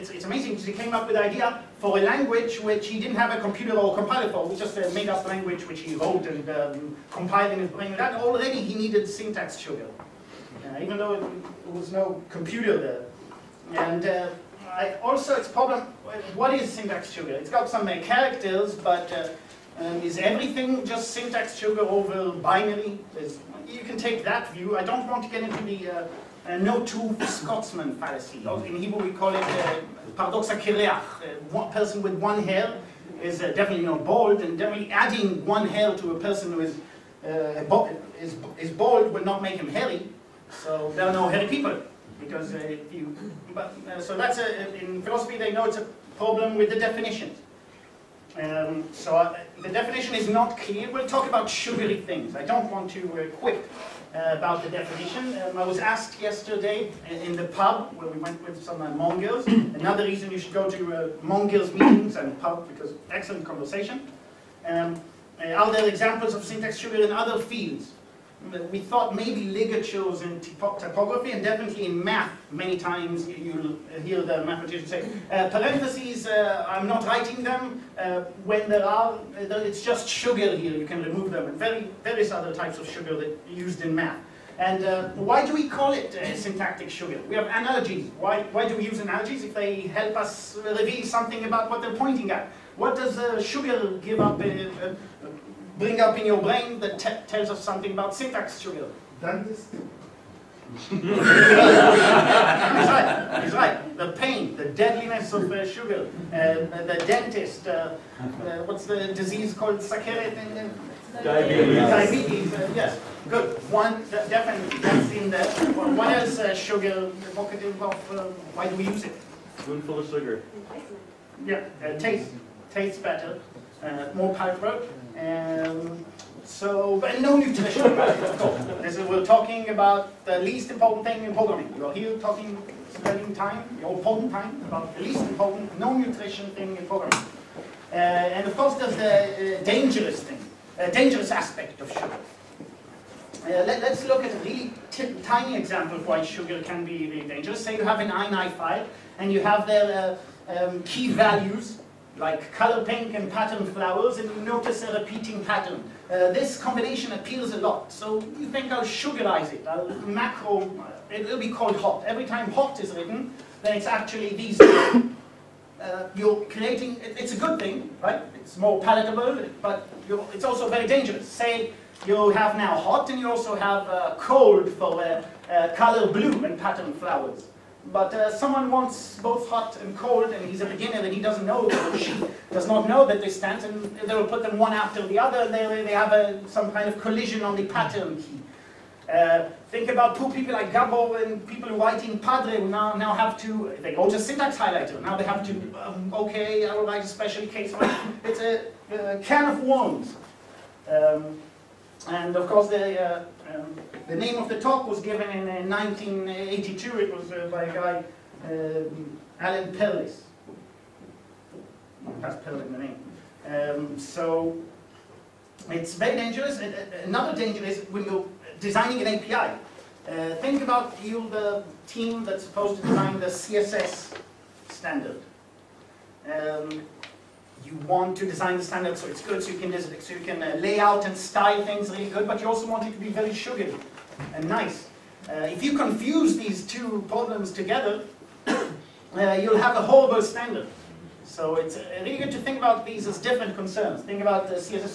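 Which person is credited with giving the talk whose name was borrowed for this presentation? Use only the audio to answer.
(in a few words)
Alan Perlis.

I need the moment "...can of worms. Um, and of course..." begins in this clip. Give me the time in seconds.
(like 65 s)
199 s.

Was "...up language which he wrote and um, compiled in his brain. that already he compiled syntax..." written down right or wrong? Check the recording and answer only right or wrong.
wrong.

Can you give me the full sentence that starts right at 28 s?
In Hebrew we call it uh, kireach.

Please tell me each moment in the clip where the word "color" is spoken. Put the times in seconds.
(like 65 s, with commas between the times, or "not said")
152 s, 175 s.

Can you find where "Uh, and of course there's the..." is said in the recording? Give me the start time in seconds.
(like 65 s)
137 s.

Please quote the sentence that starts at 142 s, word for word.
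Uh, let, us look at a really tiny example of why sugar can be really dangerous.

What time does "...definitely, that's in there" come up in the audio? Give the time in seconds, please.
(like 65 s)
114 s.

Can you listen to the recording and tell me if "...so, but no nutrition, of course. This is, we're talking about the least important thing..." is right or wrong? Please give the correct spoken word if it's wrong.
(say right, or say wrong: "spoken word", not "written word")
right.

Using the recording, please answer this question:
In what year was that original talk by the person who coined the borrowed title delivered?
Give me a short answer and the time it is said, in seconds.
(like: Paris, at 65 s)
1982, at 205 s.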